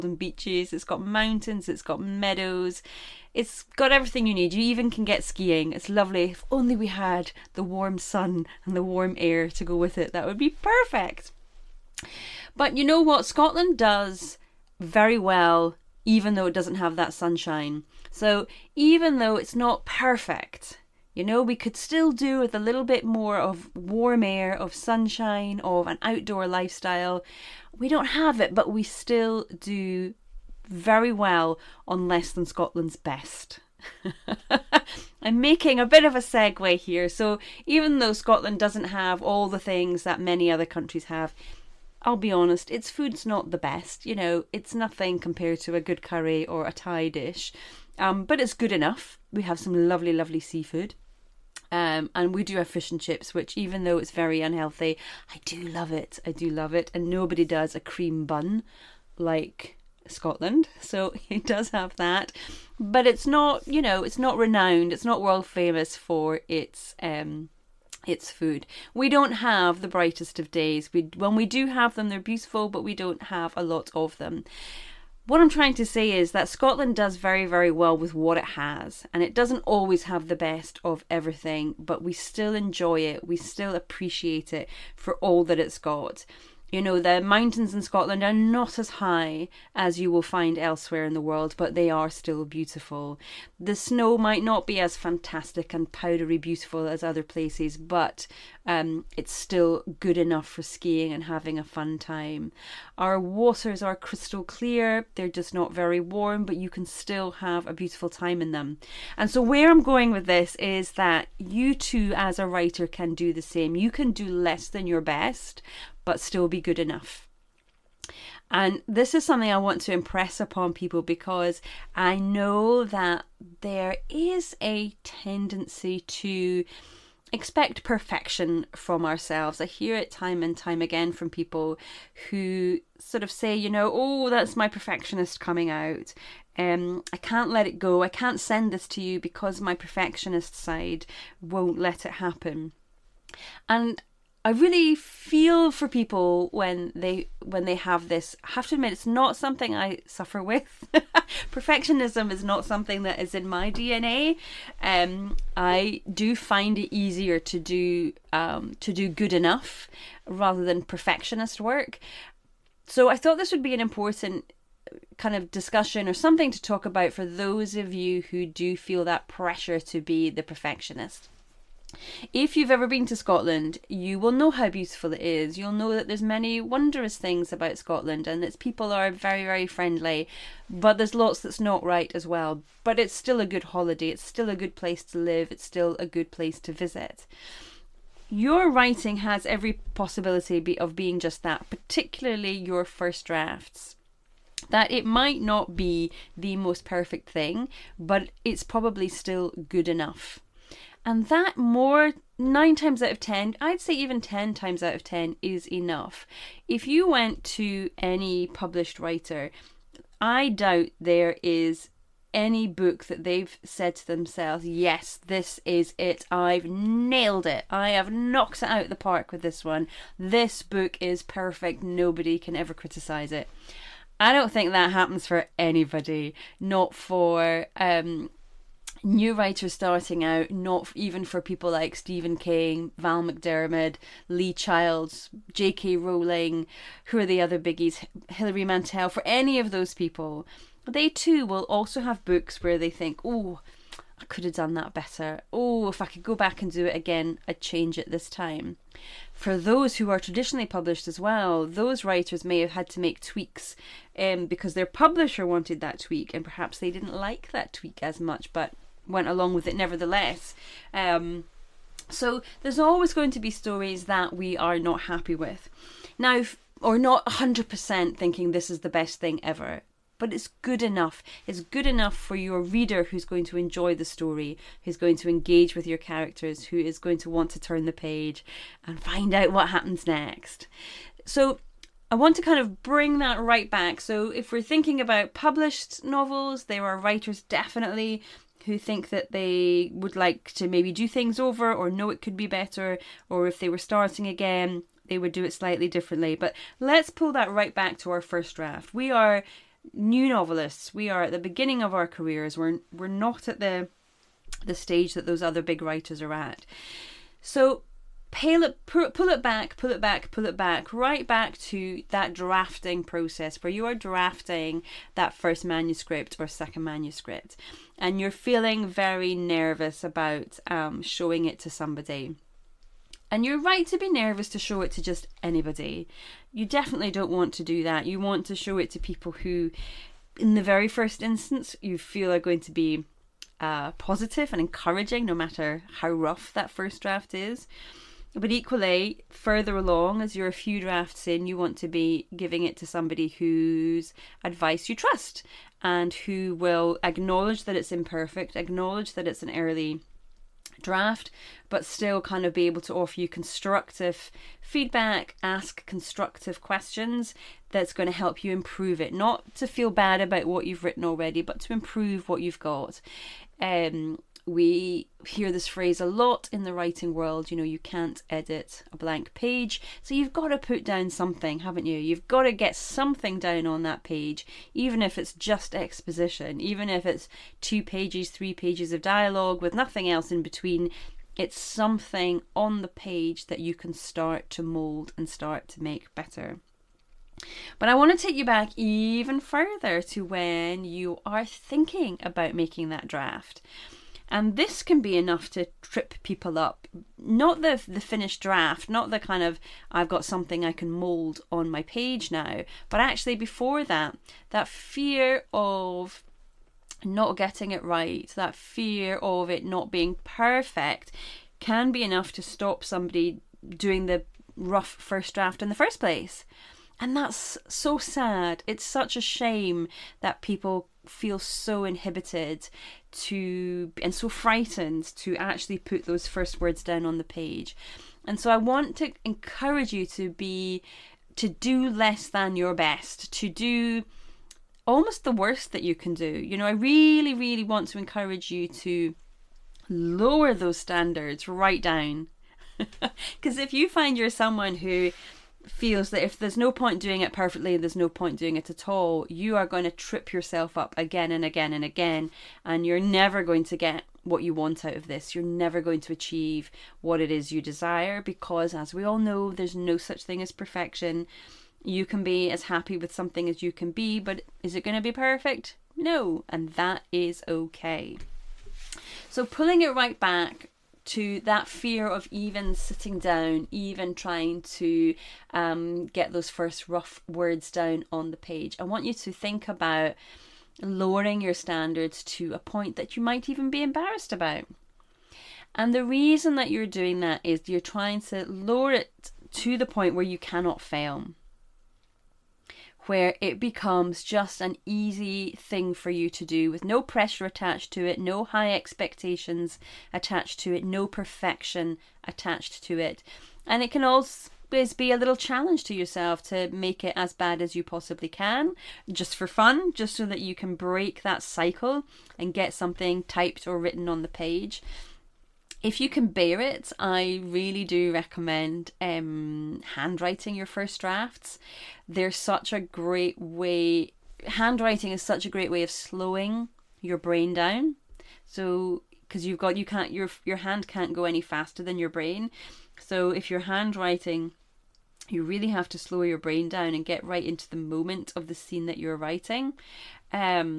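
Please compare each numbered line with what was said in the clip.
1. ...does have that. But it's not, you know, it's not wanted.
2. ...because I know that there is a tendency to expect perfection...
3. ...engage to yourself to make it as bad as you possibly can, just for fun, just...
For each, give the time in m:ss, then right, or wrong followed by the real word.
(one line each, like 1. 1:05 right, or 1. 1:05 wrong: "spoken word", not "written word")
1. 1:01 wrong: "renowned", not "wanted"
2. 2:01 right
3. 8:25 wrong: "challenge", not "engage".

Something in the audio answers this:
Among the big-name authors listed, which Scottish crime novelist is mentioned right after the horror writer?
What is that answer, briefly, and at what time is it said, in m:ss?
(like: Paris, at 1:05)
Val McDermid, at 3:52.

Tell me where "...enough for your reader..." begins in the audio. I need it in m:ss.
4:31.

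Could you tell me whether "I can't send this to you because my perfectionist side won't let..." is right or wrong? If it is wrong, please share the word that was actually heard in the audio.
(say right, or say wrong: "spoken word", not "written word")
right.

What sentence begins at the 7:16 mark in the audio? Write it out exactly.
You know, I really really want to encourage you to lower those standards right down.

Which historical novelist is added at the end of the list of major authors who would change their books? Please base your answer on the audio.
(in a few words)
Hilary Mantel.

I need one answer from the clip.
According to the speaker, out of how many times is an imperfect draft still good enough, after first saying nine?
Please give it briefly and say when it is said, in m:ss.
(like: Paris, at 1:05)
10 times out of 10, at 3:24.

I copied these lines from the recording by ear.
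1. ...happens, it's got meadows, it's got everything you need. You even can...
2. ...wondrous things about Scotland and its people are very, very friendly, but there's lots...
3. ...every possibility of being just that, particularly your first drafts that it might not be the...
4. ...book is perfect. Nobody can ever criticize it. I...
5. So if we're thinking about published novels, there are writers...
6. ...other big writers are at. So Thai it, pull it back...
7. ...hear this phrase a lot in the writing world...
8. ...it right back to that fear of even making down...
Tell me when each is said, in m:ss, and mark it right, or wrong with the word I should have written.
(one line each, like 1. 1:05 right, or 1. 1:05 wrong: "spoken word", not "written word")
1. 0:01 wrong: "mountains", not "happens"
2. 2:56 right
3. 3:09 right
4. 3:40 right
5. 4:43 right
6. 5:05 wrong: "Pull", not "Thai"
7. 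6:05 right
8. 7:49 wrong: "sitting", not "making".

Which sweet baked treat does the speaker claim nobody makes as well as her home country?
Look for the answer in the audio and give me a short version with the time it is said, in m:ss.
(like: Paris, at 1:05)
Cream bun, at 0:57.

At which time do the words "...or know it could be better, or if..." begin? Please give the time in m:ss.
4:51.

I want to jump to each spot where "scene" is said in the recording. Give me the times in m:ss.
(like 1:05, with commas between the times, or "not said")
8:58.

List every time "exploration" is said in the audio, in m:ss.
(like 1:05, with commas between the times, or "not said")
not said.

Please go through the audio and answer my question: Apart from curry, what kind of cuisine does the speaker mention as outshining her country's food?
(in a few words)
Thai.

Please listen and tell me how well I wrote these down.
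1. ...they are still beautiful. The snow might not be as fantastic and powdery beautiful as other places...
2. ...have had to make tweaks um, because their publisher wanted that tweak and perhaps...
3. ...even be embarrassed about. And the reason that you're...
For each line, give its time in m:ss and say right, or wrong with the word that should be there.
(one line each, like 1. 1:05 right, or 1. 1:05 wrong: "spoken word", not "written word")
1. 1:31 right
2. 4:12 right
3. 8:03 right.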